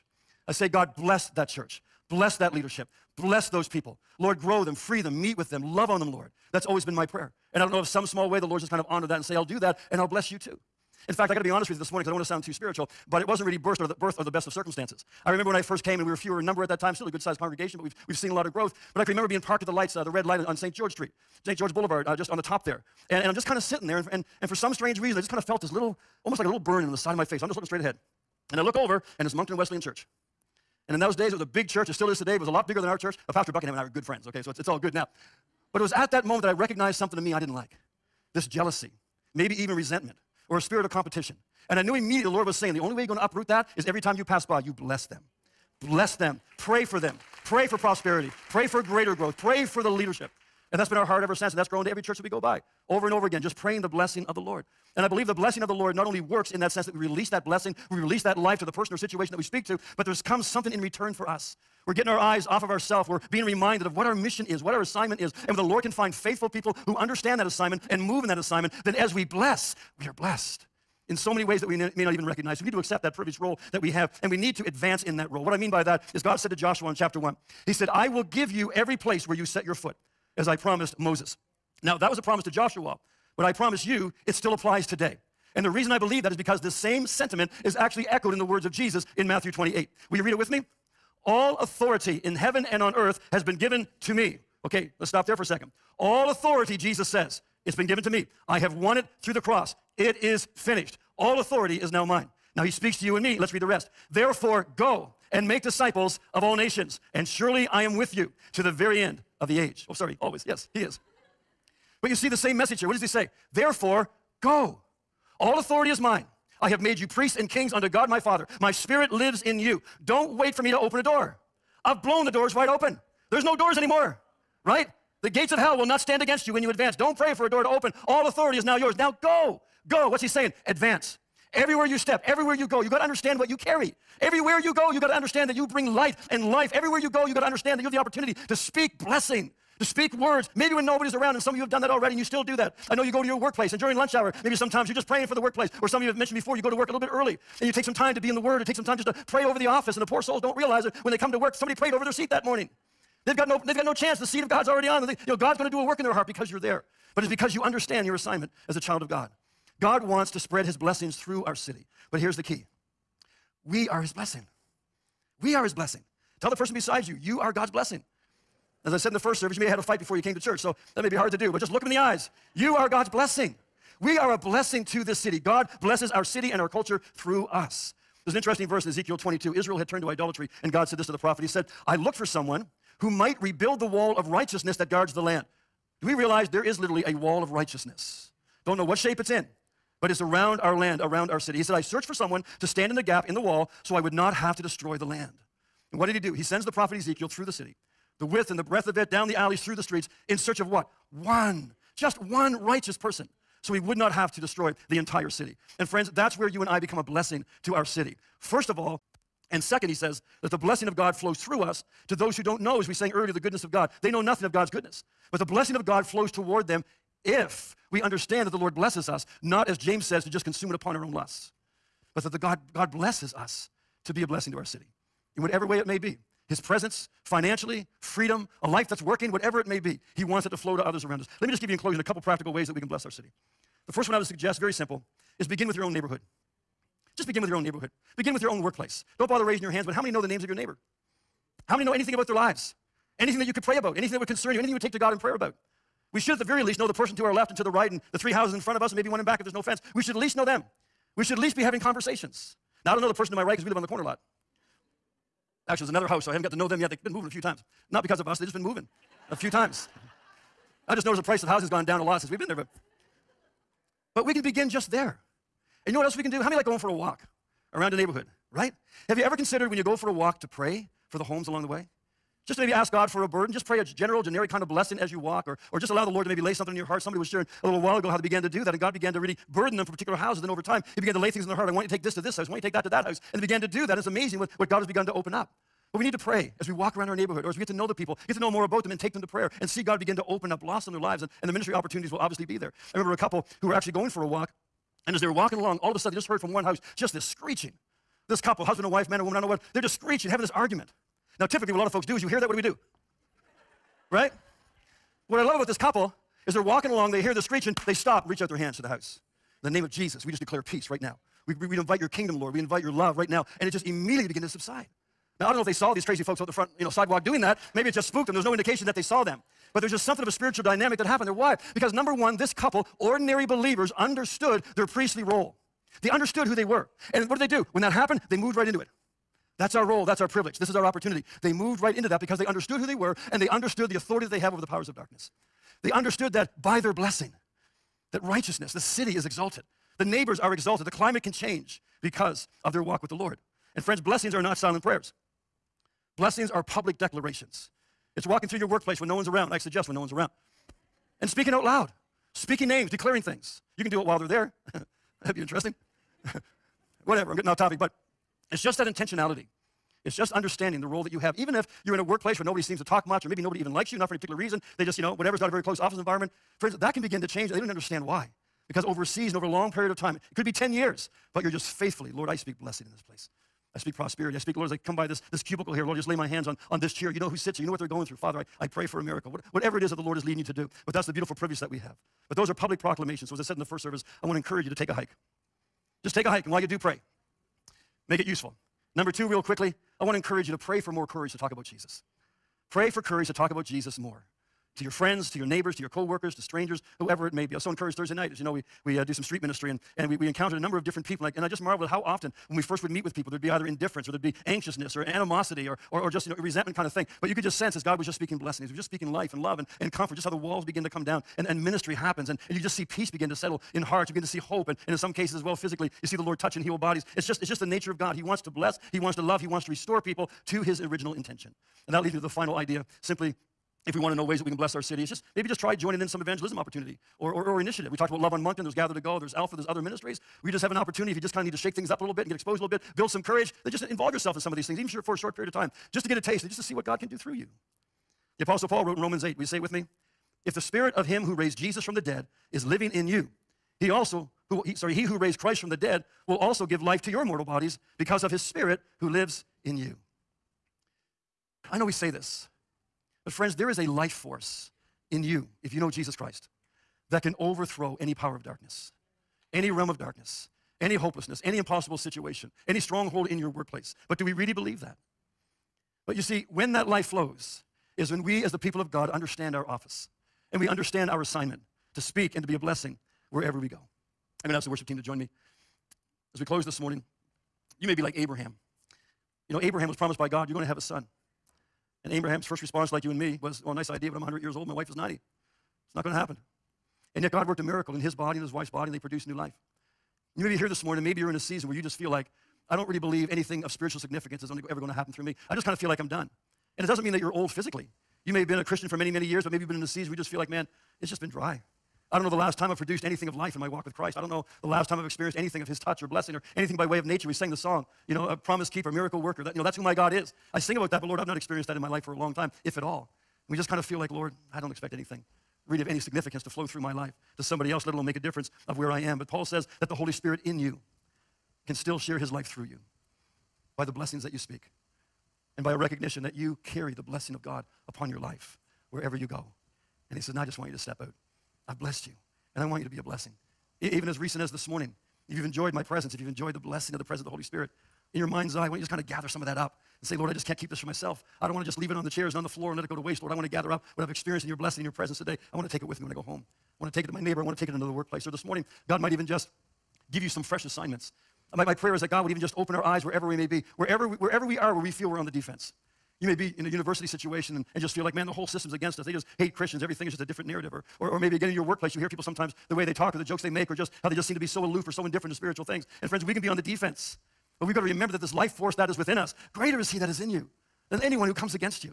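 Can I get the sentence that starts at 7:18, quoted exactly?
The Apostle Paul wrote in Romans 8, will you say it with me?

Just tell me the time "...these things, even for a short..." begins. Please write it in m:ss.
7:14.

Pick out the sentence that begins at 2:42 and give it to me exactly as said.
But here's the key we are his blessing.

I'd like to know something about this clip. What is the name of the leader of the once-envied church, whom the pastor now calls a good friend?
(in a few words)
Pastor Buckingham.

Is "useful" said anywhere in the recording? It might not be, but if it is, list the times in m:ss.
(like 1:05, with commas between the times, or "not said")
6:28.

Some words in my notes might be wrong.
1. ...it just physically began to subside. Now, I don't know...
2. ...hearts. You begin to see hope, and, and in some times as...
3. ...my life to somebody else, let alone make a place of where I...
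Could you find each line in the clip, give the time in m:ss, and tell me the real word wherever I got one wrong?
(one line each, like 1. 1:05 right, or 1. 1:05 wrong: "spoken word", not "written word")
1. 5:13 wrong: "immediately", not "physically"
2. 6:53 wrong: "cases", not "times"
3. 8:36 wrong: "difference", not "place".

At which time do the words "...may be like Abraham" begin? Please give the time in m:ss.
7:57.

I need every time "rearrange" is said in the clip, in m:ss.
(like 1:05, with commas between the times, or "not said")
not said.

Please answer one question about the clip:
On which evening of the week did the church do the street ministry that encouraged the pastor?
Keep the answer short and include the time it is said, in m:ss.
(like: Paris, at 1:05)
Thursday, at 6:37.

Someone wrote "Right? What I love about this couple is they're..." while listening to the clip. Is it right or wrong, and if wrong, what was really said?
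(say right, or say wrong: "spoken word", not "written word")
right.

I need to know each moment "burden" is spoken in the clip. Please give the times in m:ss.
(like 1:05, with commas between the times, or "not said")
4:33, 4:39.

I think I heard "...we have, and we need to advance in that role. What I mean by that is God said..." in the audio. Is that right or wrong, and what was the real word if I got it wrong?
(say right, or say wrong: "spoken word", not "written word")
right.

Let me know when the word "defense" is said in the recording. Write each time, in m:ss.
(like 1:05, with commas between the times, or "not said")
9:15, 9:26.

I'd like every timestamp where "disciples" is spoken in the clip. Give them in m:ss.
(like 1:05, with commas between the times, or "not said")
1:45.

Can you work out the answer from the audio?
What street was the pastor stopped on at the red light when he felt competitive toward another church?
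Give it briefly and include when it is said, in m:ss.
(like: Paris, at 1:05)
St. George Boulevard, at 0:21.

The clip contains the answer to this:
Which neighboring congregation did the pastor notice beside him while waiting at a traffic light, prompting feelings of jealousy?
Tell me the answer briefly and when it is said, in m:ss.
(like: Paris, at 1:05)
Moncton Wesleyan Church, at 0:29.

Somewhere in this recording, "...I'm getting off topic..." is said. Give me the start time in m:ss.
5:57.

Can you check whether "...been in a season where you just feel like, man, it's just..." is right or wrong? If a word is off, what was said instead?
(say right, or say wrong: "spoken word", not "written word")
right.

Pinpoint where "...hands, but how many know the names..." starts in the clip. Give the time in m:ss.
3:59.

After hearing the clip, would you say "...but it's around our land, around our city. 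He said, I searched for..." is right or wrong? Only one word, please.
right.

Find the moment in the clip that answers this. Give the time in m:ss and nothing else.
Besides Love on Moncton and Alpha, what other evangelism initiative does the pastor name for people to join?
7:08.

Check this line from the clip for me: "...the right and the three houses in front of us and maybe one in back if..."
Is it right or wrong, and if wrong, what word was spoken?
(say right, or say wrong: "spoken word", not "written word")
right.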